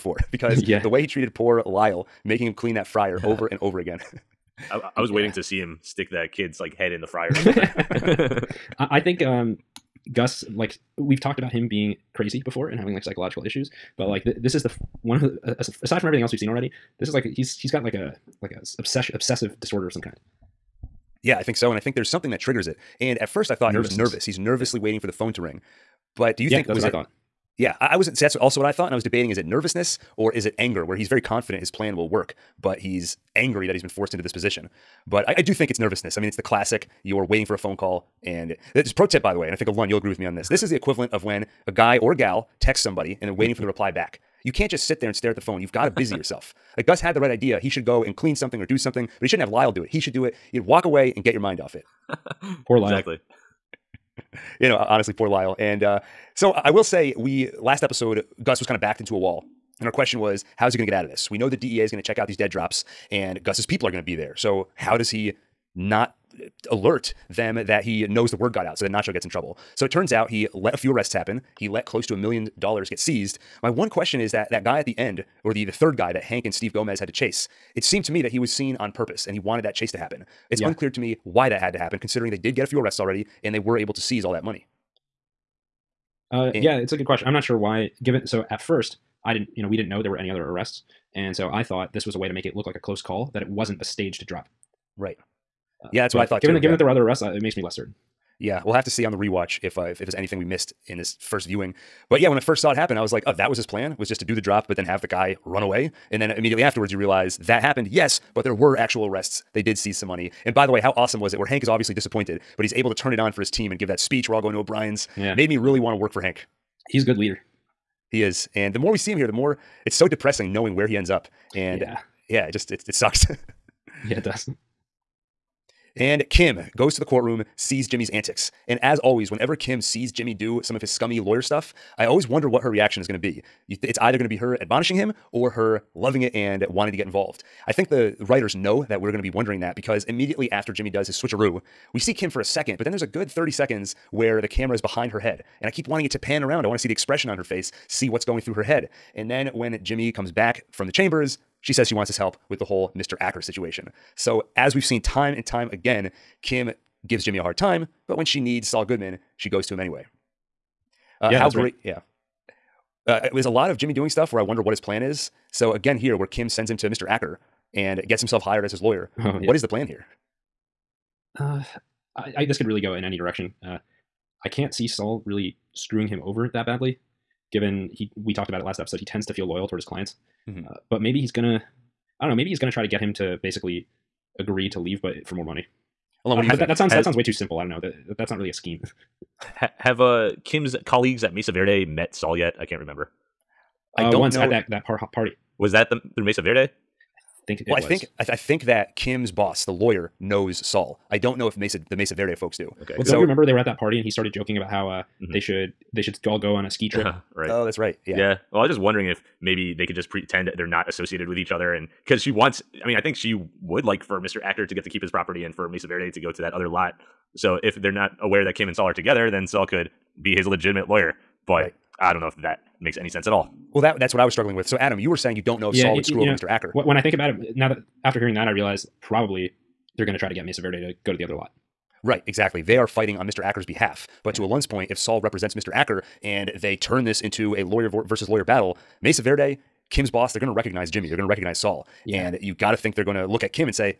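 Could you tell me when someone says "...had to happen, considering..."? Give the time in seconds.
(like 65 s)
81 s.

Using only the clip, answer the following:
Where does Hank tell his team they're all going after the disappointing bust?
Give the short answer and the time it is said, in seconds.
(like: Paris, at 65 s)
O'Brien's, at 114 s.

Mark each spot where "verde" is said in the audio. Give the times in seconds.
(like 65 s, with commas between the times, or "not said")
191 s, 196 s, 202 s, 215 s, 230 s, 239 s.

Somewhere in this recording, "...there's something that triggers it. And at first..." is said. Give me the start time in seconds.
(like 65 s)
21 s.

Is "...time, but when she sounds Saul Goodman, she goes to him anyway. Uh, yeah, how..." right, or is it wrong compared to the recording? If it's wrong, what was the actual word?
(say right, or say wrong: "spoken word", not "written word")
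wrong: "needs", not "sounds".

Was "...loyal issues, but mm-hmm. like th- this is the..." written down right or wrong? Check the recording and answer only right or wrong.
wrong.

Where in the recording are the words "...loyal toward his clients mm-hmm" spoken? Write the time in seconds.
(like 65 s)
179 s.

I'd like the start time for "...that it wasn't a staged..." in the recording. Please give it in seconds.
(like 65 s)
93 s.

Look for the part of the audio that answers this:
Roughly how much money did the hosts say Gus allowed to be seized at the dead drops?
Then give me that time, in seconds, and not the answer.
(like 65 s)
71 s.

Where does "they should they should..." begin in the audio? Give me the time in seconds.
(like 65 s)
205 s.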